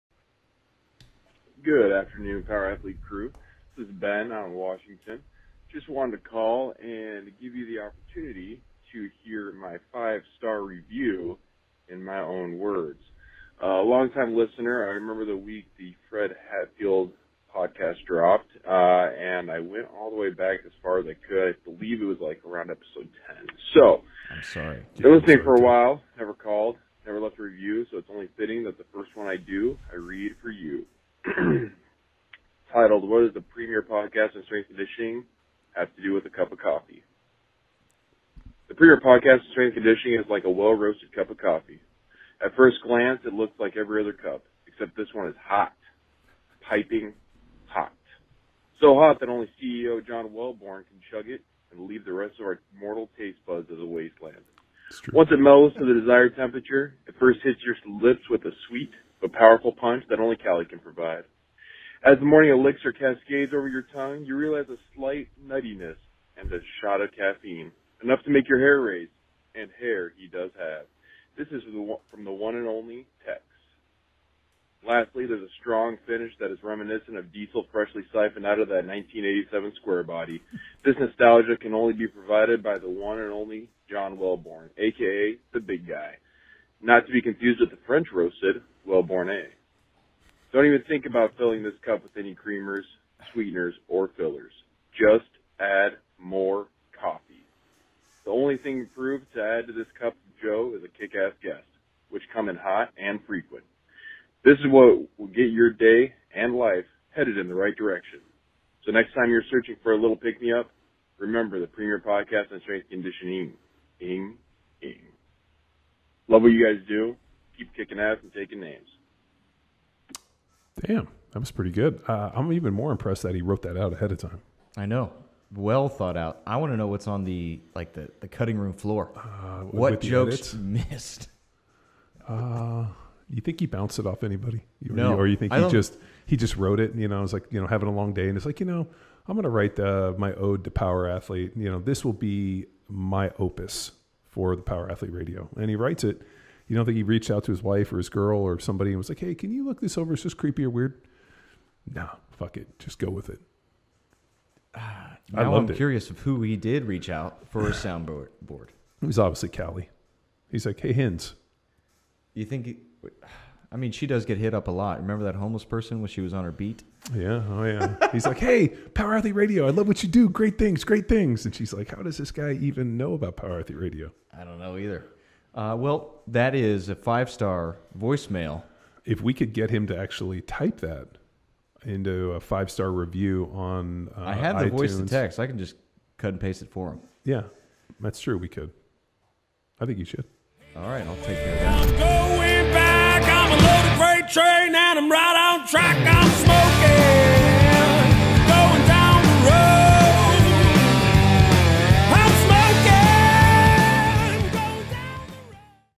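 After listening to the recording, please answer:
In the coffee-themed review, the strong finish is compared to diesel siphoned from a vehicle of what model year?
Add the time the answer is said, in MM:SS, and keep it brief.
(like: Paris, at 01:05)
1987, at 01:18.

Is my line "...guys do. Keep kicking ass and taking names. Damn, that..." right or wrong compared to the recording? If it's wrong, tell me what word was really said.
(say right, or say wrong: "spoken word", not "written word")
right.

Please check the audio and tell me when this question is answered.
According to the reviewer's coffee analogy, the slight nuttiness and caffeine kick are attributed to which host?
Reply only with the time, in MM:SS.
01:13.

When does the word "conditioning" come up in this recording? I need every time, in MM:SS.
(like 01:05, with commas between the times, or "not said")
00:34, 00:39, 01:52.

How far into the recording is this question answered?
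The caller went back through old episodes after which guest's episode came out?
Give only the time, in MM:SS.
00:16.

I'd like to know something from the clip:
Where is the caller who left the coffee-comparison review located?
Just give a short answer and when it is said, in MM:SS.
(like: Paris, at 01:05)
Washington, at 00:04.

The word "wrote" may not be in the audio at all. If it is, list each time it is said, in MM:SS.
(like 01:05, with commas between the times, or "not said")
02:03, 02:16.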